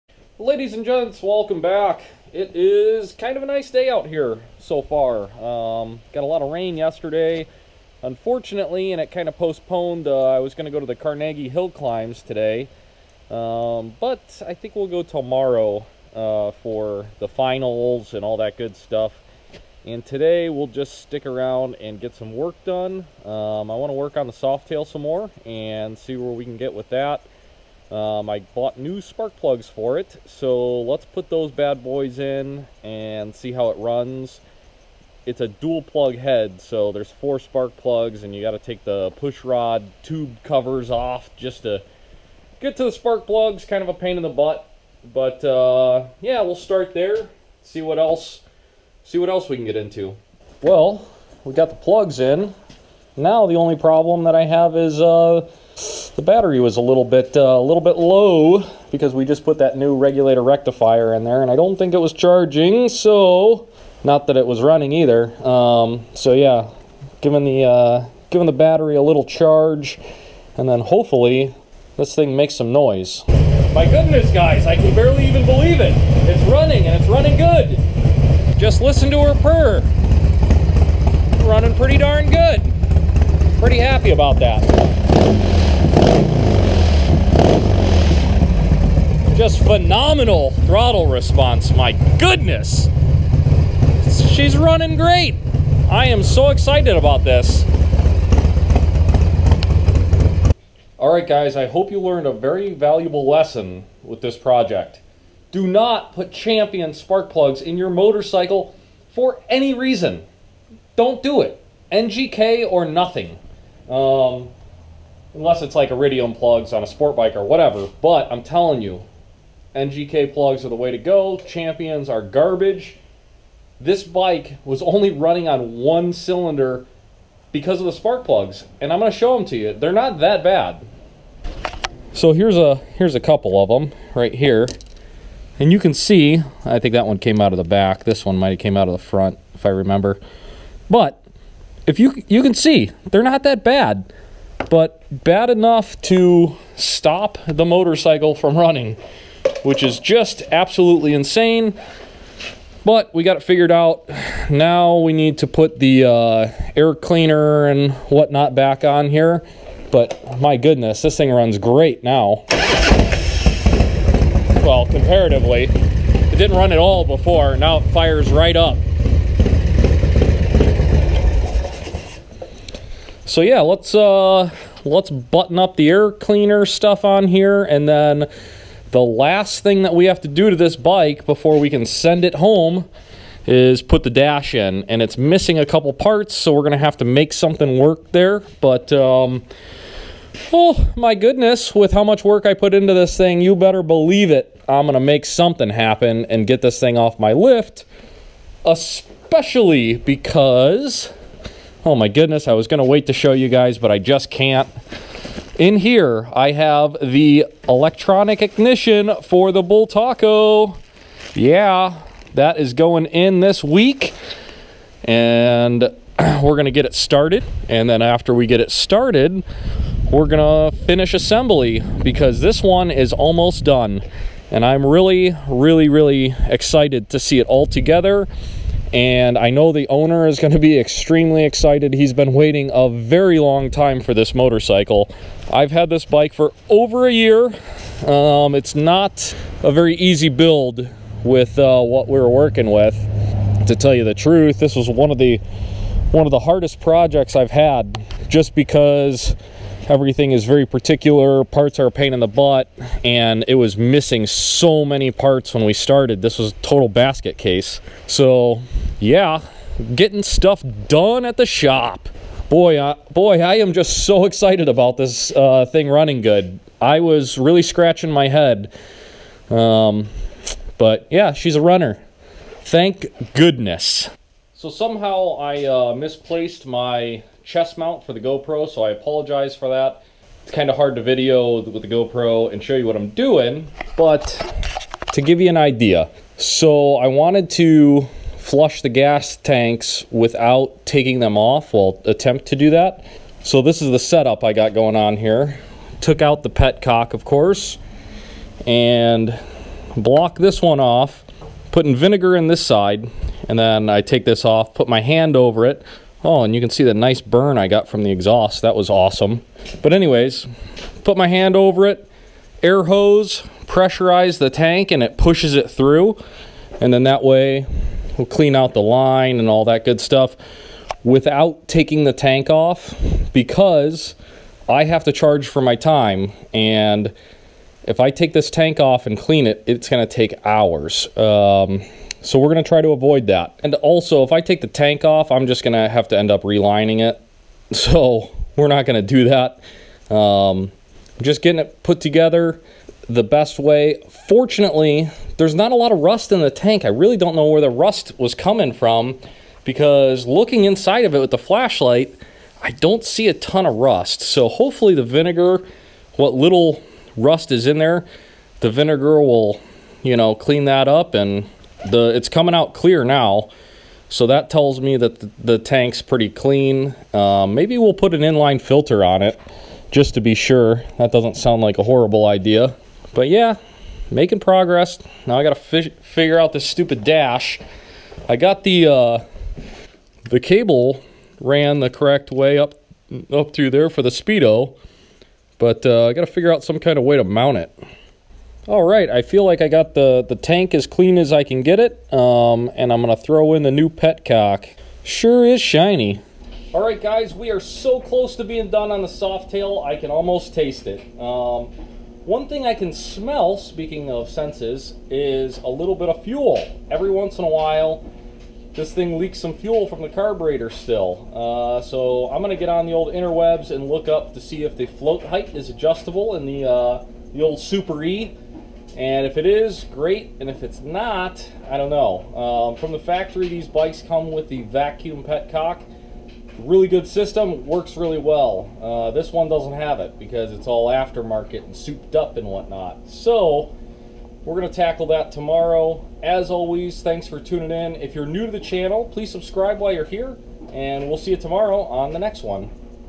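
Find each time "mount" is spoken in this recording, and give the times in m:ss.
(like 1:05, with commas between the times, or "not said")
4:37, 6:27.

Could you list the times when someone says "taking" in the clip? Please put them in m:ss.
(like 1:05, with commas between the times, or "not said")
4:50, 5:21.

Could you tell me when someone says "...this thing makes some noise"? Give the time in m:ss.
1:11.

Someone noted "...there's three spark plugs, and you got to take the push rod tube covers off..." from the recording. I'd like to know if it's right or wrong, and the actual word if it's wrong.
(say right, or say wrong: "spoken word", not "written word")
wrong: "four", not "three".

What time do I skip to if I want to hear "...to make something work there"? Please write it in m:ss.
3:06.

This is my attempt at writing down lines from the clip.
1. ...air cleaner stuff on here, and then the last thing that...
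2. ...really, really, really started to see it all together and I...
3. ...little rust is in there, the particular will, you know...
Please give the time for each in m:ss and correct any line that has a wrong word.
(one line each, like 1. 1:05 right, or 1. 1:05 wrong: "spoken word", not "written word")
1. 2:55 right
2. 3:44 wrong: "excited", not "started"
3. 5:56 wrong: "vinegar", not "particular".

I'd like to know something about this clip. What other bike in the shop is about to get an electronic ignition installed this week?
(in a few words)
Bull Taco.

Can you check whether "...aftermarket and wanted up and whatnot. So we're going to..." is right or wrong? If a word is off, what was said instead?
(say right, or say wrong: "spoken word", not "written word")
wrong: "souped", not "wanted".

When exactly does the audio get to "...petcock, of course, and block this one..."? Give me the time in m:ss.
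4:56.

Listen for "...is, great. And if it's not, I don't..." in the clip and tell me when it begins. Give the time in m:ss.
6:59.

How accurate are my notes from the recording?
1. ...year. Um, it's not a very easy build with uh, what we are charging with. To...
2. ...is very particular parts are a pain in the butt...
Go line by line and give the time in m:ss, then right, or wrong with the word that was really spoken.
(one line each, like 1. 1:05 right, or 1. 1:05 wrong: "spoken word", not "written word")
1. 3:57 wrong: "working", not "charging"
2. 4:10 right.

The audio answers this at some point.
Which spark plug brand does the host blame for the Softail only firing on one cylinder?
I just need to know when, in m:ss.
1:46.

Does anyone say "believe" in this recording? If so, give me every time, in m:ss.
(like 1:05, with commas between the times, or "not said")
1:15, 3:13.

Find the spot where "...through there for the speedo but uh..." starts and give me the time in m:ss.
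6:23.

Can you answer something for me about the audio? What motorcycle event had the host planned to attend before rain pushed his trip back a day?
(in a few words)
Carnegie Hill climbs.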